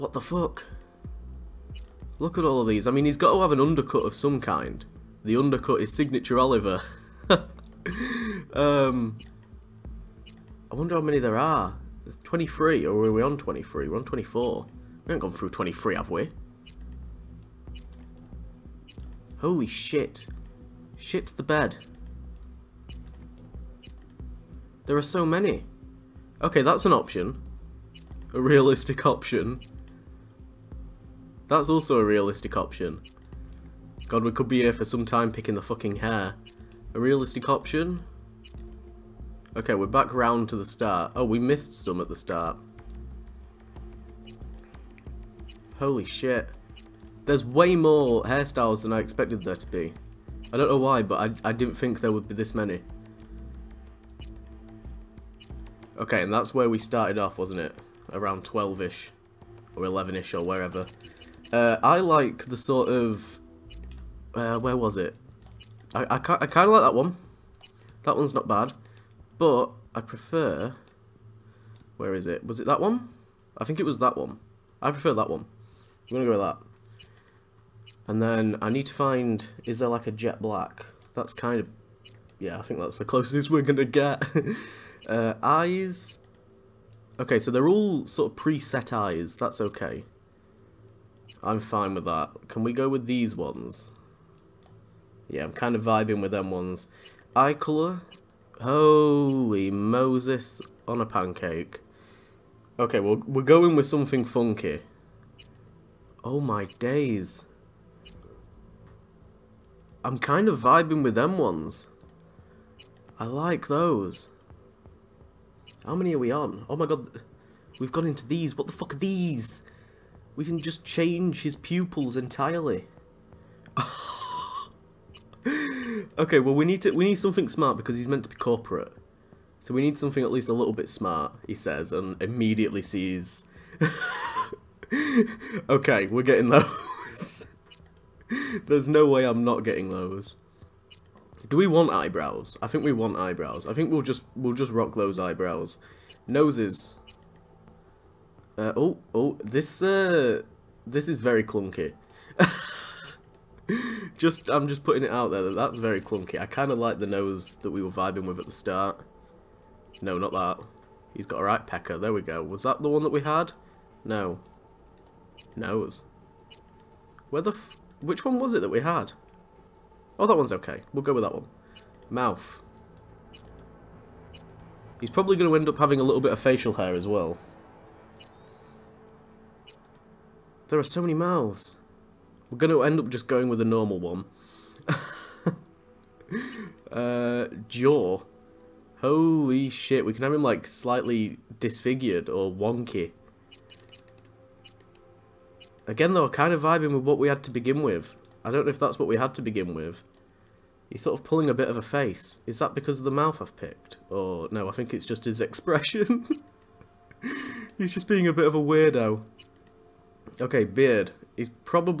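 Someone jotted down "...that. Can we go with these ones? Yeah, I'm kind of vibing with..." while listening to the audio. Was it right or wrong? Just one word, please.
right.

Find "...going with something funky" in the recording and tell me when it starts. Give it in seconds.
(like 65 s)
103 s.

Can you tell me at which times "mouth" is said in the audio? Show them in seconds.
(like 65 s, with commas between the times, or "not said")
172 s, 181 s, 203 s.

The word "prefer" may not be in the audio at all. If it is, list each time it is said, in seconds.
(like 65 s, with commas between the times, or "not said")
69 s, 74 s.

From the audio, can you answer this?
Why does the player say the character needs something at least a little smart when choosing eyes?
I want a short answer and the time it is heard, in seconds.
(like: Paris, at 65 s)
He's meant to be corporate, at 127 s.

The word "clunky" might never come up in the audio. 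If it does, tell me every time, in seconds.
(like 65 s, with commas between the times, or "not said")
151 s, 155 s.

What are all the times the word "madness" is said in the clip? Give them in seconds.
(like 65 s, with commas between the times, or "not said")
not said.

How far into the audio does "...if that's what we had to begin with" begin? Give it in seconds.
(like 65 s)
198 s.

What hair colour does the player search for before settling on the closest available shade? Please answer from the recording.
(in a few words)
Jet black.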